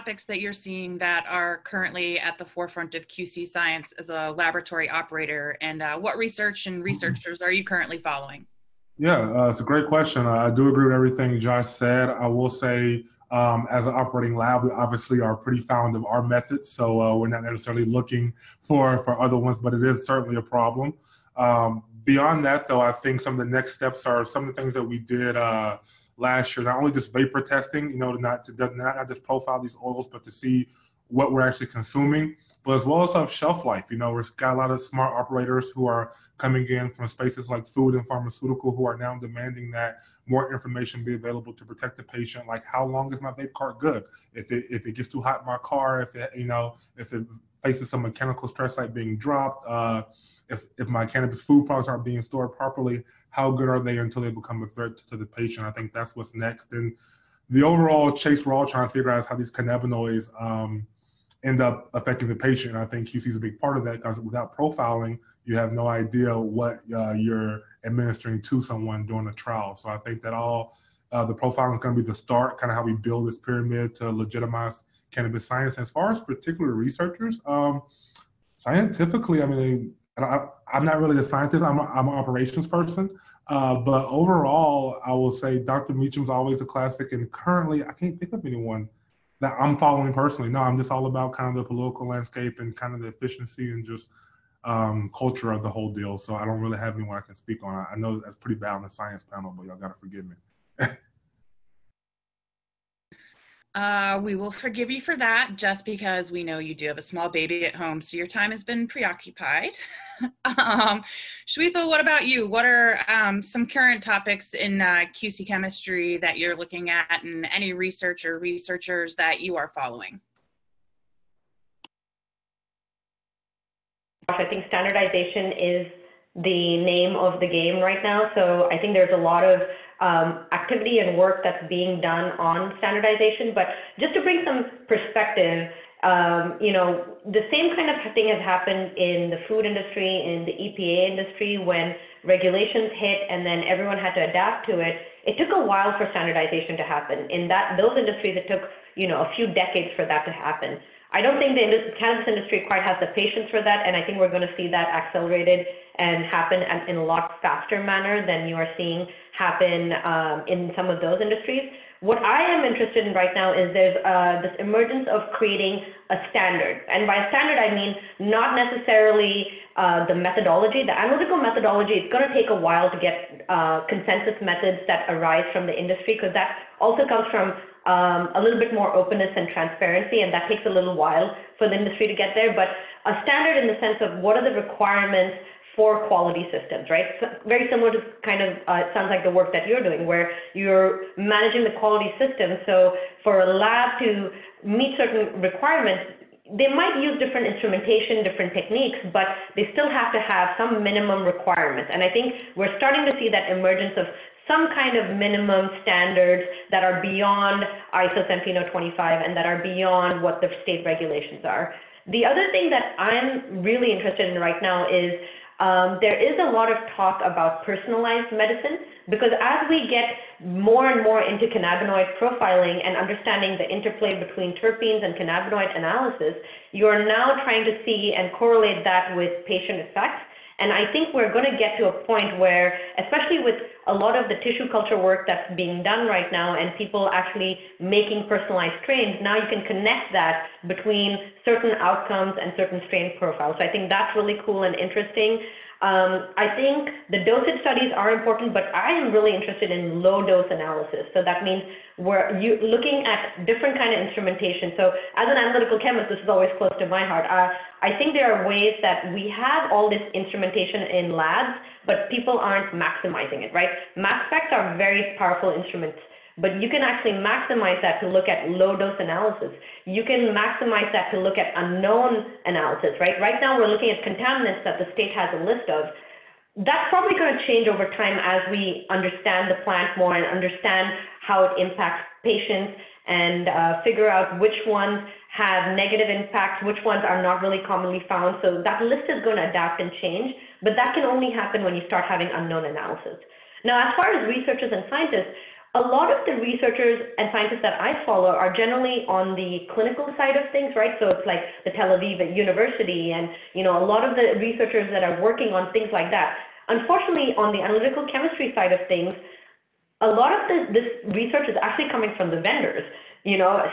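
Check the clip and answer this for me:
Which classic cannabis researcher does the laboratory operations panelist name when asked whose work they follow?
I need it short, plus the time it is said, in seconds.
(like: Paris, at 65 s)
Dr. Mechoulam, at 85 s.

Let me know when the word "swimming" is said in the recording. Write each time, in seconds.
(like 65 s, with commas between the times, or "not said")
not said.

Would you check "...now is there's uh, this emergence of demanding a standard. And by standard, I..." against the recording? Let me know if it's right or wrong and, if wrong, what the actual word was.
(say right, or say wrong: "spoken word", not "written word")
wrong: "creating", not "demanding".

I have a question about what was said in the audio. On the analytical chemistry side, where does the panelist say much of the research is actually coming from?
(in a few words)
The vendors.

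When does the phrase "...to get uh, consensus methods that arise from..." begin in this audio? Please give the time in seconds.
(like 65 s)
172 s.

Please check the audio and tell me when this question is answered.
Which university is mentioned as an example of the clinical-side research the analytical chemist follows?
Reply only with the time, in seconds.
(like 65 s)
301 s.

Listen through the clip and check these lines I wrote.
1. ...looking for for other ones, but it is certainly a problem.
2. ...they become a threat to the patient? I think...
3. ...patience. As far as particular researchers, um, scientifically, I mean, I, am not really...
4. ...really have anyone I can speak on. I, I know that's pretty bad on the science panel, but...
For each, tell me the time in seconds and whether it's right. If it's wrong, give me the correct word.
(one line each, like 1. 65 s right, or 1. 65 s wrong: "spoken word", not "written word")
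1. 17 s right
2. 54 s right
3. 75 s wrong: "science", not "patience"
4. 96 s right.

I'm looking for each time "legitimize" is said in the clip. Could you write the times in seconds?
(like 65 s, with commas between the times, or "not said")
74 s.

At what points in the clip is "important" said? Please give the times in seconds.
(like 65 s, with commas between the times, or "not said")
248 s.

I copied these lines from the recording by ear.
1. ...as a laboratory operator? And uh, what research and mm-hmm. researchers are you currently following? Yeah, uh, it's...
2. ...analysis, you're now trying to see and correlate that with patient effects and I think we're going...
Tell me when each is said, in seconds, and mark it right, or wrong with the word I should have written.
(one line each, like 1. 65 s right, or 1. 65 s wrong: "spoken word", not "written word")
1. 3 s right
2. 225 s right.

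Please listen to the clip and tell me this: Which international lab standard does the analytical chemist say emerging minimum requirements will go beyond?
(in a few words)
ISO 17025.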